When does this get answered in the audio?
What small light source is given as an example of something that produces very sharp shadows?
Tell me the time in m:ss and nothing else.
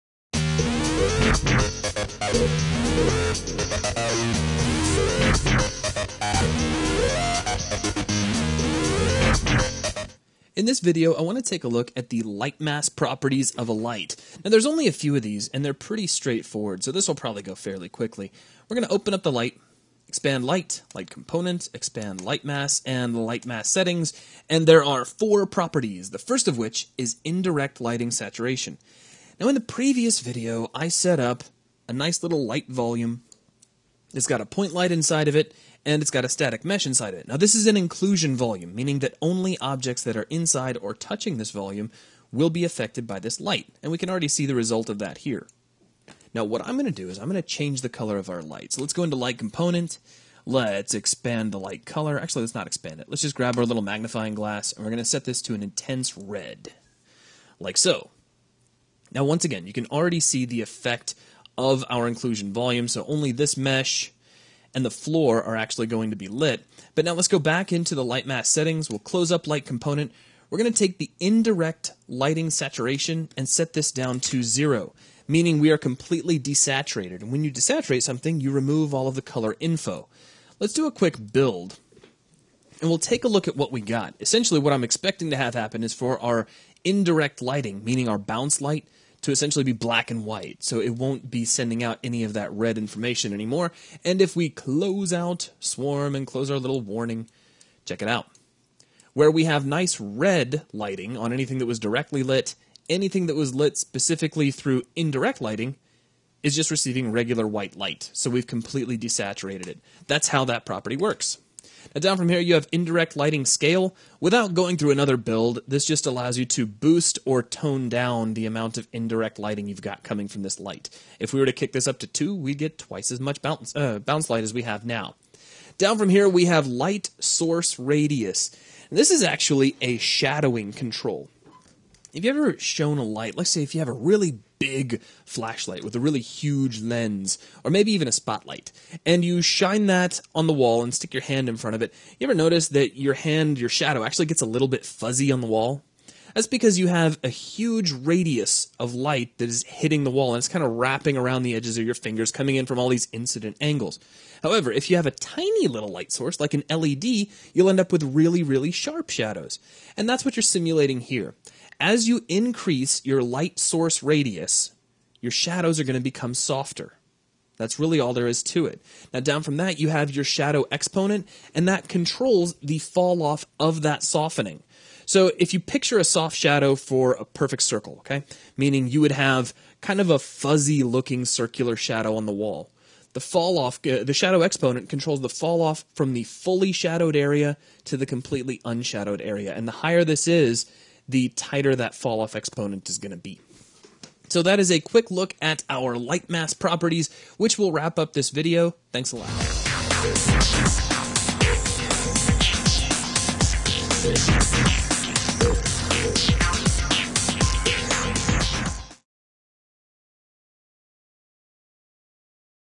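2:36.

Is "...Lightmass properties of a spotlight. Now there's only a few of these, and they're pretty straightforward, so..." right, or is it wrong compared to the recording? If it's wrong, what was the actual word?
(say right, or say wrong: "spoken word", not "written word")
wrong: "light", not "spotlight".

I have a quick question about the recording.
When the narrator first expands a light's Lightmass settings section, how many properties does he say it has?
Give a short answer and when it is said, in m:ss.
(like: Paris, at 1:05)
4, at 0:25.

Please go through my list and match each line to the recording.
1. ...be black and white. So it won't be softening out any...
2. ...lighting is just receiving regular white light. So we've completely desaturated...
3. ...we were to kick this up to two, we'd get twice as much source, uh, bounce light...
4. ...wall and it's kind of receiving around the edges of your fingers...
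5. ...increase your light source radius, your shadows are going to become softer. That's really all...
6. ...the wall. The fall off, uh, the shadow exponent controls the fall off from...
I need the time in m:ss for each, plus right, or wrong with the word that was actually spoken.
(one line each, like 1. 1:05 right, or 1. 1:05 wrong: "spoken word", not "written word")
1. 1:29 wrong: "sending", not "softening"
2. 1:45 right
3. 2:01 wrong: "bounce", not "source"
4. 2:30 wrong: "wrapping", not "receiving"
5. 2:42 right
6. 3:02 right.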